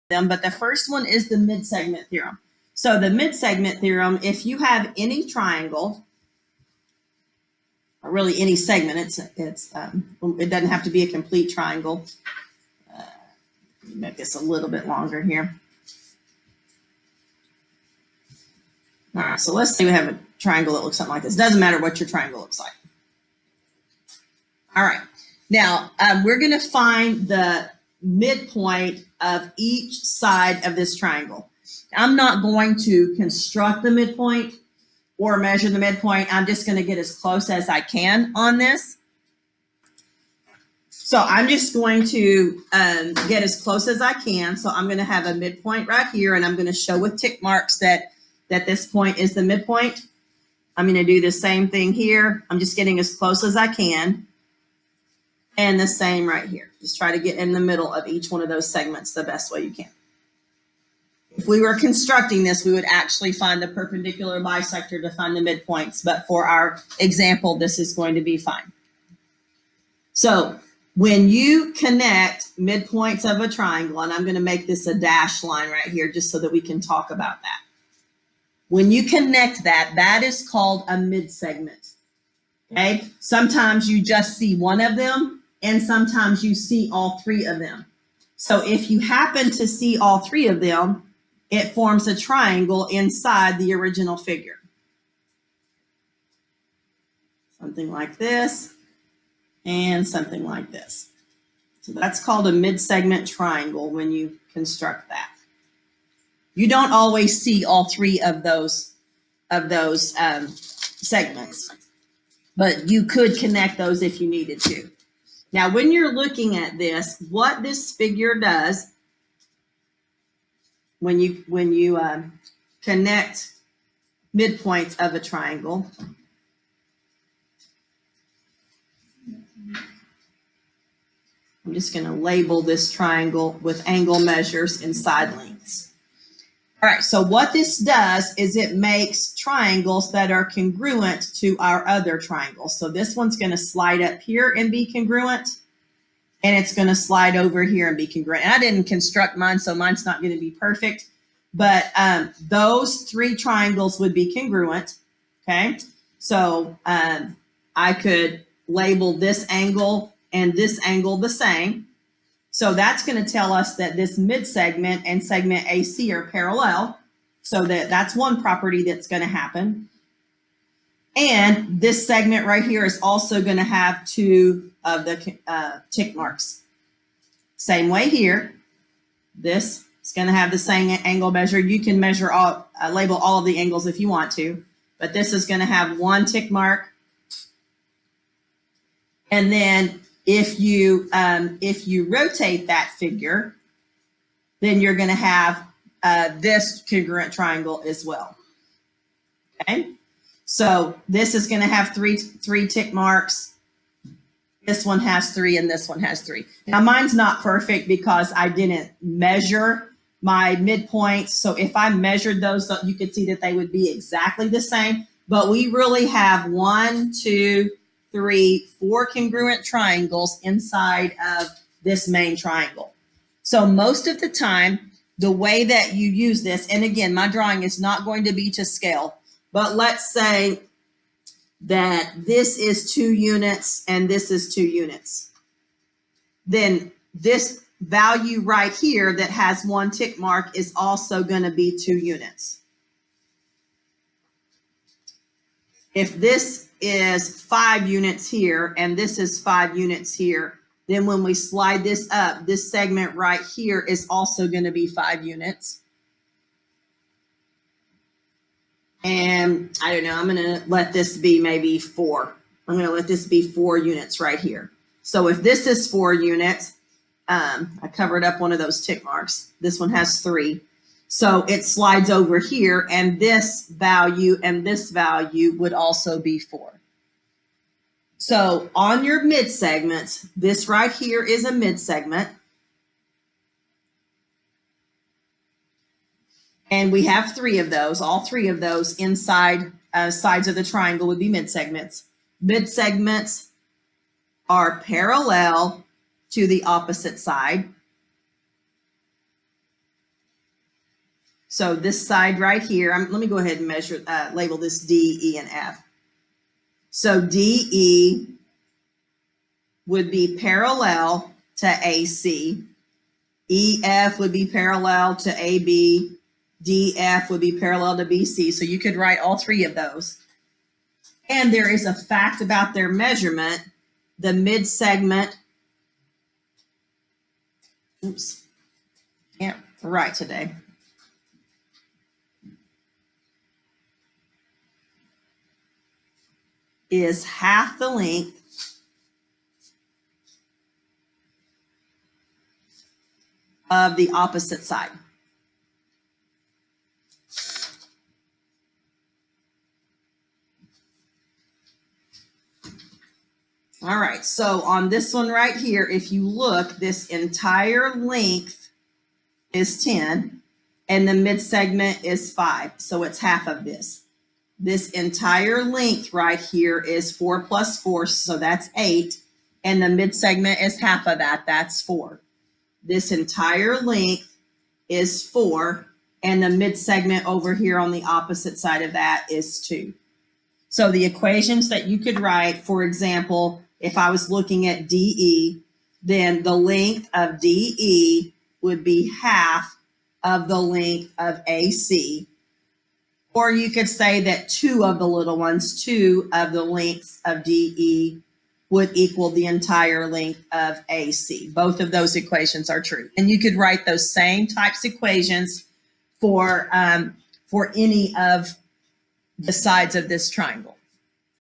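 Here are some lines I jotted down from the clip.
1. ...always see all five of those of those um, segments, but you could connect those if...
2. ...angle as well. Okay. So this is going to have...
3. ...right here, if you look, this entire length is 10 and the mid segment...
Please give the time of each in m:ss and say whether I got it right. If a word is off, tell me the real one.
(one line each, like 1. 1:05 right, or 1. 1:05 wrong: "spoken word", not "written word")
1. 1:46 wrong: "three", not "five"
2. 3:17 wrong: "triangle", not "angle"
3. 5:55 right.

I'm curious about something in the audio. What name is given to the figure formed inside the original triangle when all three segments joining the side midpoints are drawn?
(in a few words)
mid-segment triangle.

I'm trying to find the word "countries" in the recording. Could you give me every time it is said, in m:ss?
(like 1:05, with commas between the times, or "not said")
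not said.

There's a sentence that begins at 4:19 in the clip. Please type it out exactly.
And I don't know, I'm going to let this be maybe four.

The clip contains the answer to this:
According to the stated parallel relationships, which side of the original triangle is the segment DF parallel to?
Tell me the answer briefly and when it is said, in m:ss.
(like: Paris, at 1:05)
BC, at 5:18.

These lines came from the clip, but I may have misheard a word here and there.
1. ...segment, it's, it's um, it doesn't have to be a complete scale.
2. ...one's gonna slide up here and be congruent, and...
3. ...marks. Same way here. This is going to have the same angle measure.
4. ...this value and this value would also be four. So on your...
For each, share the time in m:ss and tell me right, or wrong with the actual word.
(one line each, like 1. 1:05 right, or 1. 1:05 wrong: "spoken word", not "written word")
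1. 0:08 wrong: "triangle", not "scale"
2. 2:23 right
3. 2:56 right
4. 4:33 right.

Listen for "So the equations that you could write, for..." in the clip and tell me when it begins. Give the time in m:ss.
6:20.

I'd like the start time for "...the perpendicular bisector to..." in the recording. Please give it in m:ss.
1:03.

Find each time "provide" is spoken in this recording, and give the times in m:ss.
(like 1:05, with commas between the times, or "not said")
not said.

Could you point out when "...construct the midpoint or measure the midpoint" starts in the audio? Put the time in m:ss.
0:33.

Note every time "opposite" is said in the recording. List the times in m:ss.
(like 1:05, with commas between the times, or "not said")
4:56, 5:44, 6:18.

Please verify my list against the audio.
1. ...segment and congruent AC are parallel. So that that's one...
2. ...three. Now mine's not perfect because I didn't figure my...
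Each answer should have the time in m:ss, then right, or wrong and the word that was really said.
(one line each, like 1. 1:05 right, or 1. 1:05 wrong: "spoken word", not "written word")
1. 2:44 wrong: "segment", not "congruent"
2. 3:26 wrong: "measure", not "figure".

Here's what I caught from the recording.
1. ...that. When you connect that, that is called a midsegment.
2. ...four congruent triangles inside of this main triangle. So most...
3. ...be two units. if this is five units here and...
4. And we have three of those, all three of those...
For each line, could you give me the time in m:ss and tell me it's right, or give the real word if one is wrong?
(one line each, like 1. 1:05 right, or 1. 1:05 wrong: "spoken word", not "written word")
1. 1:17 right
2. 3:38 right
3. 4:01 right
4. 4:46 right.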